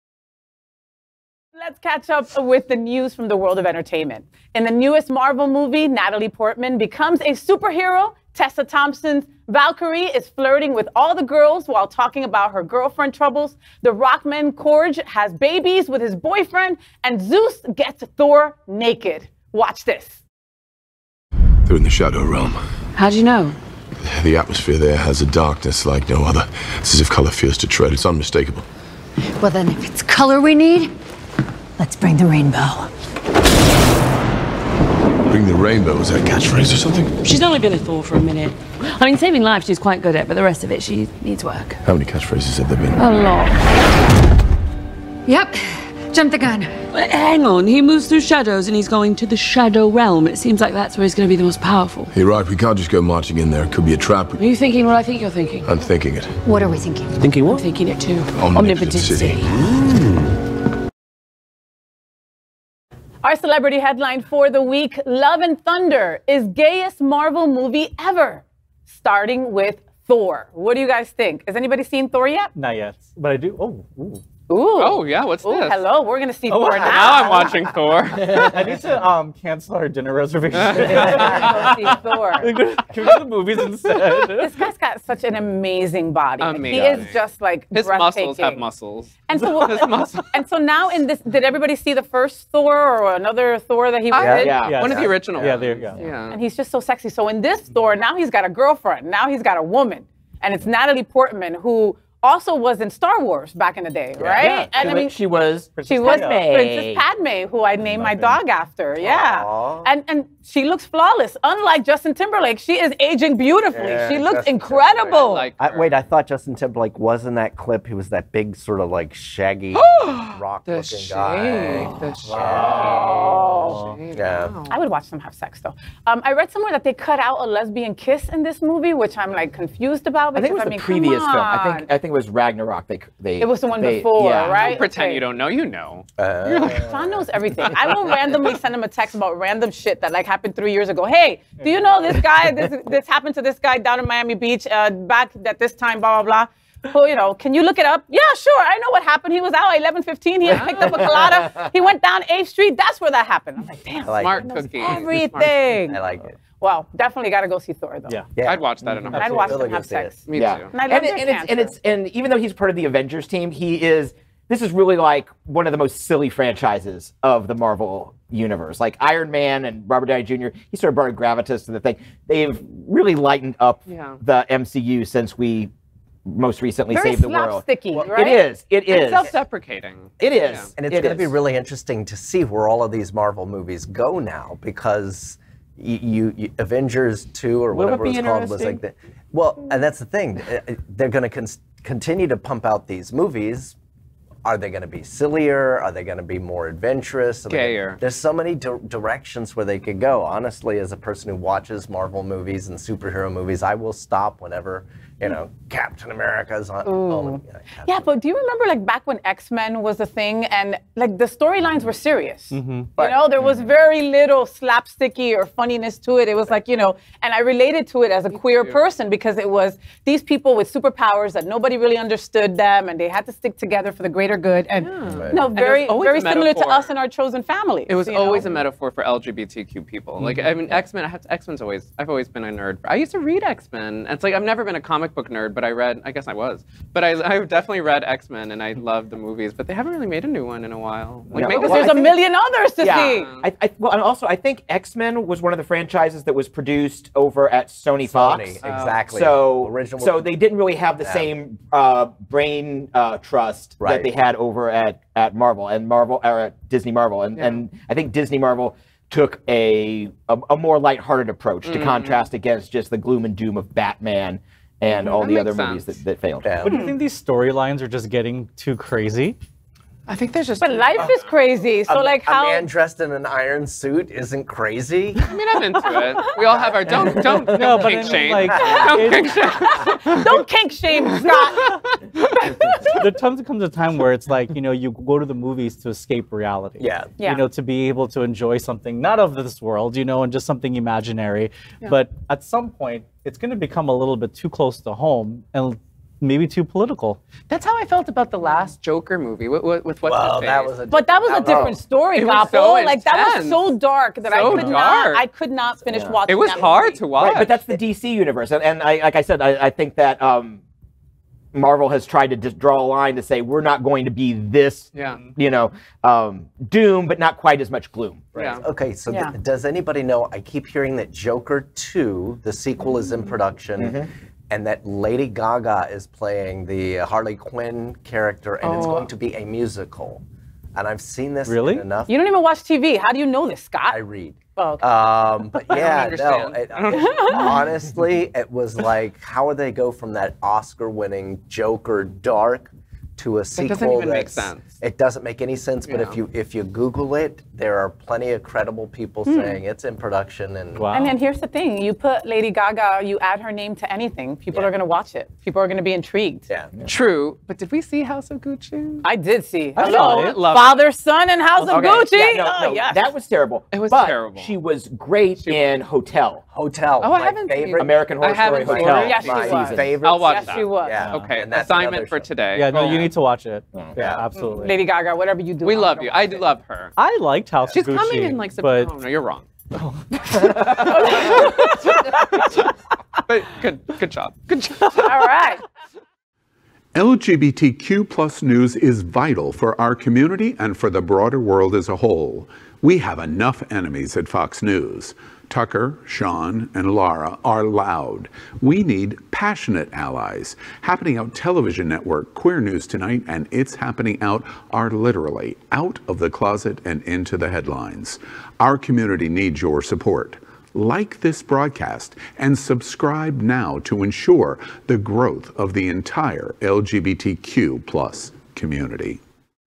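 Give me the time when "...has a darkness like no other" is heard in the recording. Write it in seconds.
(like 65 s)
24 s.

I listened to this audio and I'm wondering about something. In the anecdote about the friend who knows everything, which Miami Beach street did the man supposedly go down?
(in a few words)
8th Street.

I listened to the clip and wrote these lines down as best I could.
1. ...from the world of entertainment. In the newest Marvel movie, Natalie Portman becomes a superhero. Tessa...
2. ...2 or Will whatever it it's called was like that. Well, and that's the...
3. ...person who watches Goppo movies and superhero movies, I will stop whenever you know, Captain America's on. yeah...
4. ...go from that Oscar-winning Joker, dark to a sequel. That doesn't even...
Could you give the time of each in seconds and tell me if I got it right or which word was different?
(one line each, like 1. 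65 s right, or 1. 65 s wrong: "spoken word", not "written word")
1. 3 s right
2. 187 s right
3. 200 s wrong: "Marvel", not "Goppo"
4. 339 s right.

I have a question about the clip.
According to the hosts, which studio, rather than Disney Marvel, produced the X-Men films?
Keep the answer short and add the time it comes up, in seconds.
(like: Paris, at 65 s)
Sony Fox, at 248 s.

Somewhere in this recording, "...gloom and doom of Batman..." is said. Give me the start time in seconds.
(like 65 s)
262 s.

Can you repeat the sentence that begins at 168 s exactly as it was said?
Like Iron Man and Robert Downey Jr., he sort of brought a gravitas to the thing.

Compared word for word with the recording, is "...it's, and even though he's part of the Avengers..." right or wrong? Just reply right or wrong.
right.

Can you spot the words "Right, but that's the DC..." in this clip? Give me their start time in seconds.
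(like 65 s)
307 s.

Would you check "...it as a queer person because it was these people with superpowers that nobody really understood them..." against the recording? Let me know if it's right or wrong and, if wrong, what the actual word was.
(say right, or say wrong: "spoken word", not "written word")
right.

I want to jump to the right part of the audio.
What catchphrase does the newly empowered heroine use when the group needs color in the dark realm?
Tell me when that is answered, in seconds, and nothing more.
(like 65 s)
31 s.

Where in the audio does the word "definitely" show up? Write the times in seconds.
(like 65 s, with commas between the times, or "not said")
157 s, 237 s.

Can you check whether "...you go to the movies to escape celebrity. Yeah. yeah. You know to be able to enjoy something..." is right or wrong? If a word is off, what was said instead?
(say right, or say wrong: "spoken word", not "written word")
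wrong: "reality", not "celebrity".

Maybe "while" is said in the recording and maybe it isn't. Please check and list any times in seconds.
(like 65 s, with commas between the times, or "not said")
11 s, 240 s.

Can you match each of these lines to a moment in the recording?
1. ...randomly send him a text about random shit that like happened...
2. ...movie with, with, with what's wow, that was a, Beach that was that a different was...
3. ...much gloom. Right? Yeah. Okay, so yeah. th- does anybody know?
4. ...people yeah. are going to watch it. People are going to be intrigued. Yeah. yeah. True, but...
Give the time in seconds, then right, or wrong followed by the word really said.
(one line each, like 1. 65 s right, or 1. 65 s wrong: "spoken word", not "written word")
1. 138 s right
2. 299 s wrong: "But", not "Beach"
3. 317 s right
4. 354 s right.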